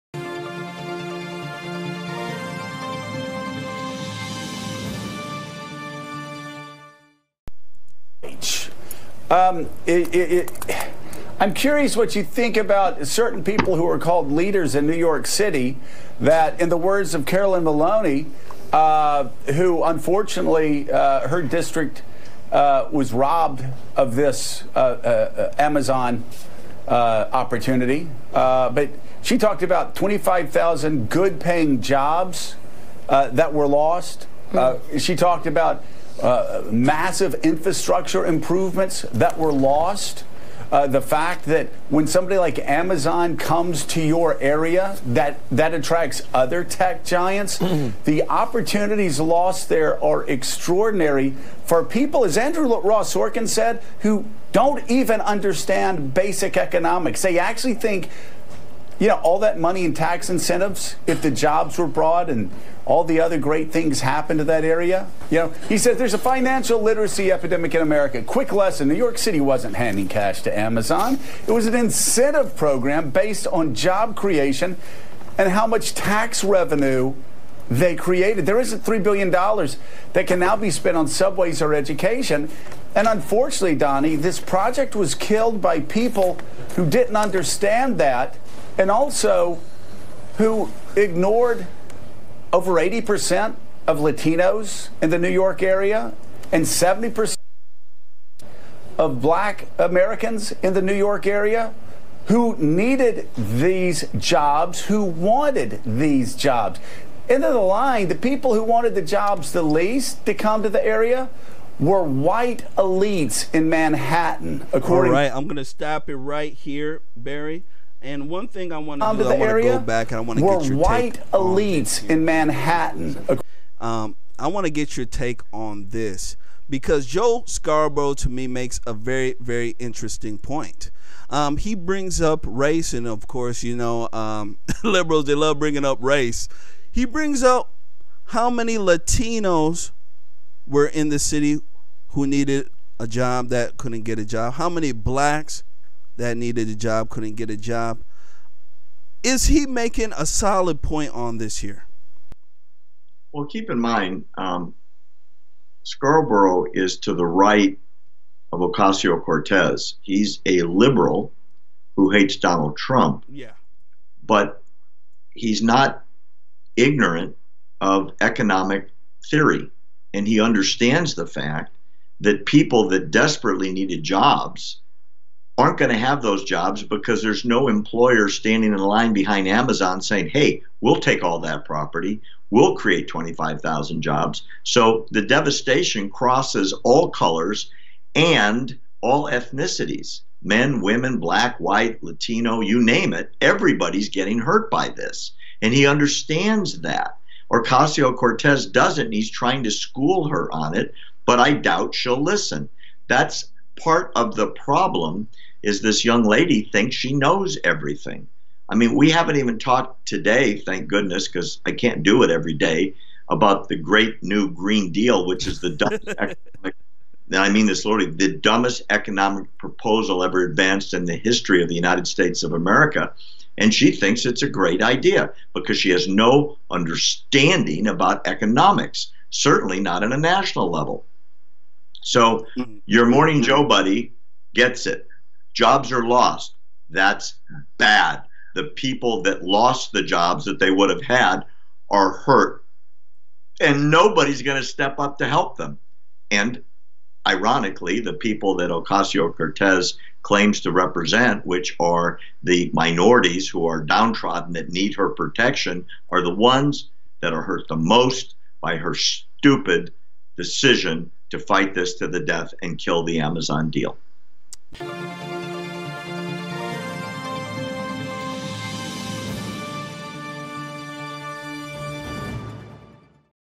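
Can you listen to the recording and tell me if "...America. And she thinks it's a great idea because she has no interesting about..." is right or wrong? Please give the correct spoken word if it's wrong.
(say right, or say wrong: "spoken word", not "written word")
wrong: "understanding", not "interesting".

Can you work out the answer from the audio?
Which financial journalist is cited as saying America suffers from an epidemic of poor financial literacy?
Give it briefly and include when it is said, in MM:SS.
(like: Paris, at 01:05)
Andrew Ross Sorkin, at 00:52.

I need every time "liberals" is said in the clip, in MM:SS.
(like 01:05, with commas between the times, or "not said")
02:14, 02:40.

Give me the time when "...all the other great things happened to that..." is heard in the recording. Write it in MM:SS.
01:02.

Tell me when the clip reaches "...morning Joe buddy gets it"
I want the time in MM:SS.
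03:53.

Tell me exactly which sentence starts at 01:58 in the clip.
And one thing I want to do, I want to go back and I want to get your white elites in Manhattan.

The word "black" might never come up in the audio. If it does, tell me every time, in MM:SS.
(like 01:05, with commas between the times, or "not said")
01:39, 02:24, 03:11.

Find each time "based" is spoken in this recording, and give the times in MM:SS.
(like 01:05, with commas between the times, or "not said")
01:13.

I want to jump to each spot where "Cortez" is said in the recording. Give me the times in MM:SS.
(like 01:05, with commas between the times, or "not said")
02:39, 03:18, 04:09.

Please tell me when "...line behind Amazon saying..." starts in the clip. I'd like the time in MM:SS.
02:58.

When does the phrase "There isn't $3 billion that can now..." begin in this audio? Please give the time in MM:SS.
01:18.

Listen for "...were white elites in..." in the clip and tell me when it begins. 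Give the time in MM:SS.
01:51.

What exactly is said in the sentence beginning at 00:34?
Uh, she talked about uh, massive infrastructure improvements that were lost.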